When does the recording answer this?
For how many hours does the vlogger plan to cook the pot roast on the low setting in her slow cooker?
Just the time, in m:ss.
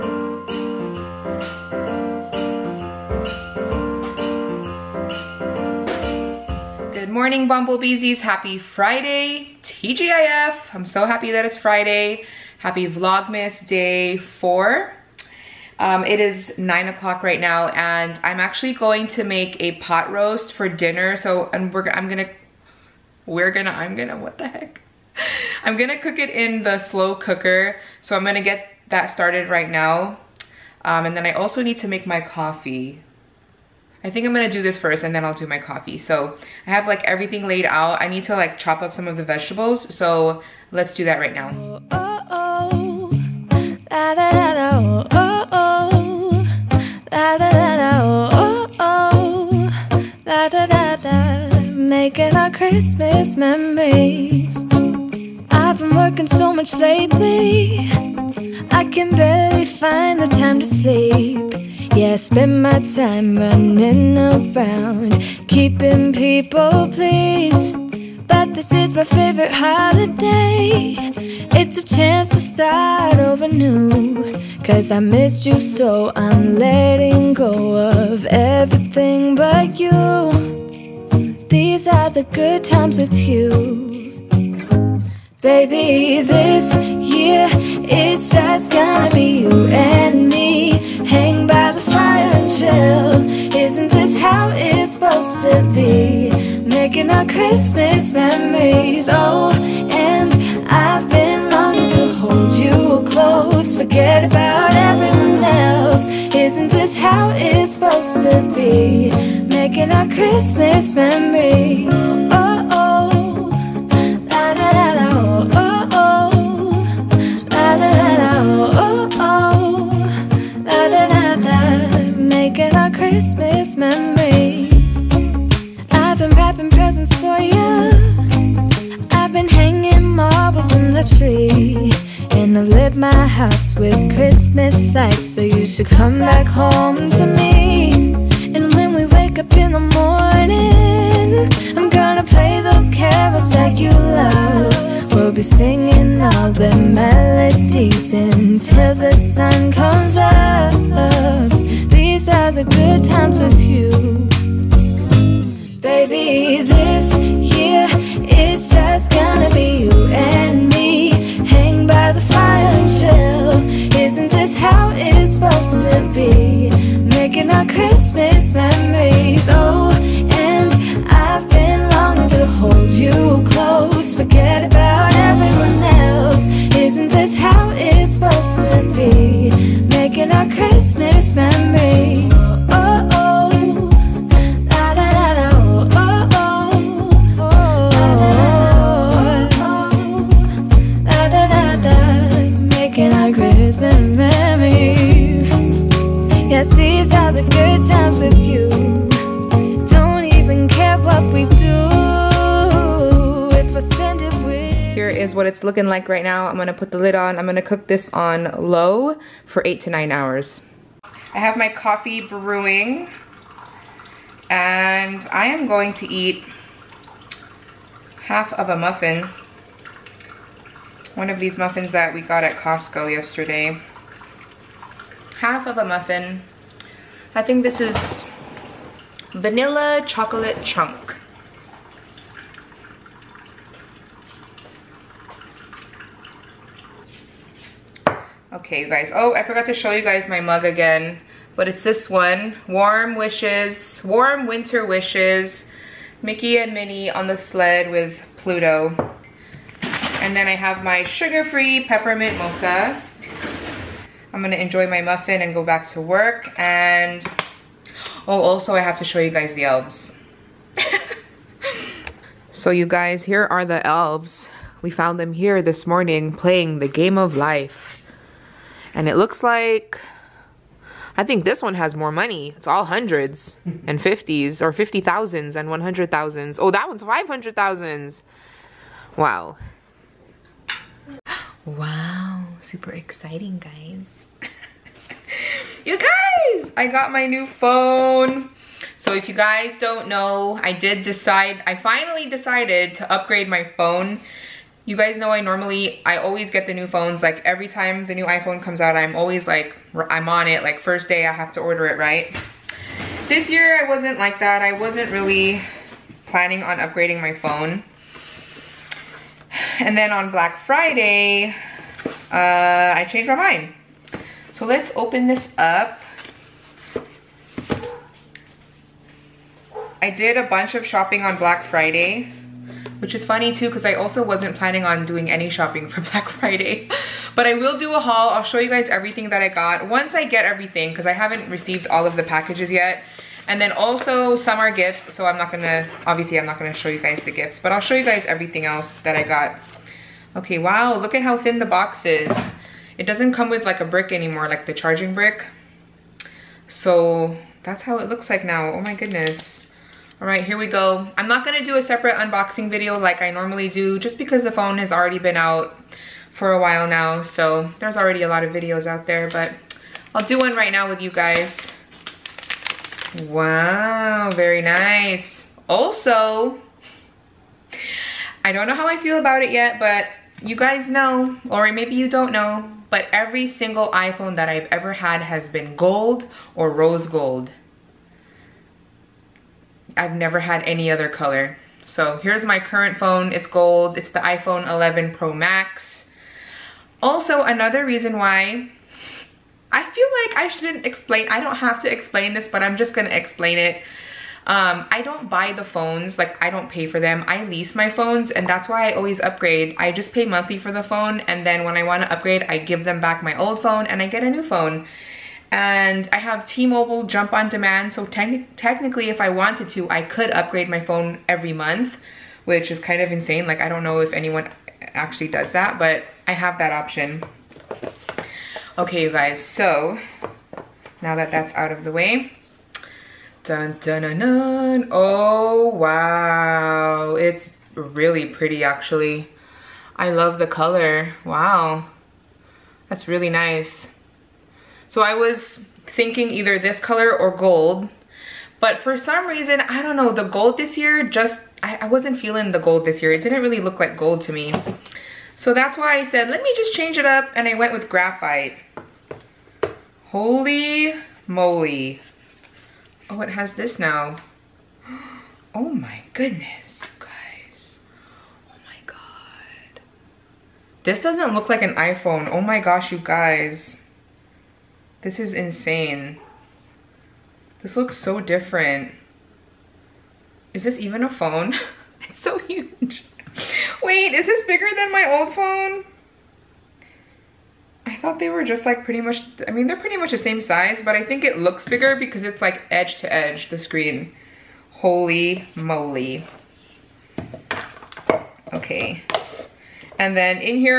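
3:29.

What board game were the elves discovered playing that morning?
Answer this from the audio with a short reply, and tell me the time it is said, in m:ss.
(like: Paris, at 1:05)
The game of life, at 4:26.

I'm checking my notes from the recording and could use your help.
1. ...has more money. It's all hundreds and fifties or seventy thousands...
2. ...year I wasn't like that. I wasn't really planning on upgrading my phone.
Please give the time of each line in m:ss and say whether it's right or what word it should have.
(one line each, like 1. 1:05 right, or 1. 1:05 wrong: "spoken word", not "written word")
1. 4:31 wrong: "fifty", not "seventy"
2. 5:03 right.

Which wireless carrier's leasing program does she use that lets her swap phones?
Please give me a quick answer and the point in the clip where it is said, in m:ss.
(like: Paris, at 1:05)
T-Mobile Jump on Demand, at 6:46.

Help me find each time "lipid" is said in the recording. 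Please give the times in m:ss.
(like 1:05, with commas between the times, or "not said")
not said.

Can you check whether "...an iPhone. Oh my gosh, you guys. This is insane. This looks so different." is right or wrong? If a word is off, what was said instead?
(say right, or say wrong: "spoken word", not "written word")
right.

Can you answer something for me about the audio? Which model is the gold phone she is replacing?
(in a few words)
iPhone 11 Pro Max.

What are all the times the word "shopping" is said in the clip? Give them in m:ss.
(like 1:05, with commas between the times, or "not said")
5:20, 5:25.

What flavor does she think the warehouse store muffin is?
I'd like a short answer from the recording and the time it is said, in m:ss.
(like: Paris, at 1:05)
Vanilla chocolate chunk, at 3:49.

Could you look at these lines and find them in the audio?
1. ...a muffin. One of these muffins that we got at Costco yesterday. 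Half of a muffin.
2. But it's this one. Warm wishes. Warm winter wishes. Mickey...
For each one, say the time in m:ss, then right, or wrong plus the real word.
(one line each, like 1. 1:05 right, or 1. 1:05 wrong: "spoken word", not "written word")
1. 3:38 right
2. 4:01 right.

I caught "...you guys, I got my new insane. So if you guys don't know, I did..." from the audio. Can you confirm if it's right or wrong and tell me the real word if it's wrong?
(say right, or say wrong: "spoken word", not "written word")
wrong: "phone", not "insane".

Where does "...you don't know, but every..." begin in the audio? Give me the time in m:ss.
6:11.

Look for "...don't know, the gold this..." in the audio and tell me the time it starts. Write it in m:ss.
7:19.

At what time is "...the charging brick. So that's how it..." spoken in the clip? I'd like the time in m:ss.
5:44.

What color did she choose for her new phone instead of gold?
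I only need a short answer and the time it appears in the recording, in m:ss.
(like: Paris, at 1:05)
Graphite, at 7:27.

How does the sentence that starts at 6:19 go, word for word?
I've never had any other color.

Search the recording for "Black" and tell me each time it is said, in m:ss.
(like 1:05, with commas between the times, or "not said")
5:10, 5:21, 5:26.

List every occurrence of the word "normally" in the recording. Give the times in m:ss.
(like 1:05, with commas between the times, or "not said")
4:55, 5:53.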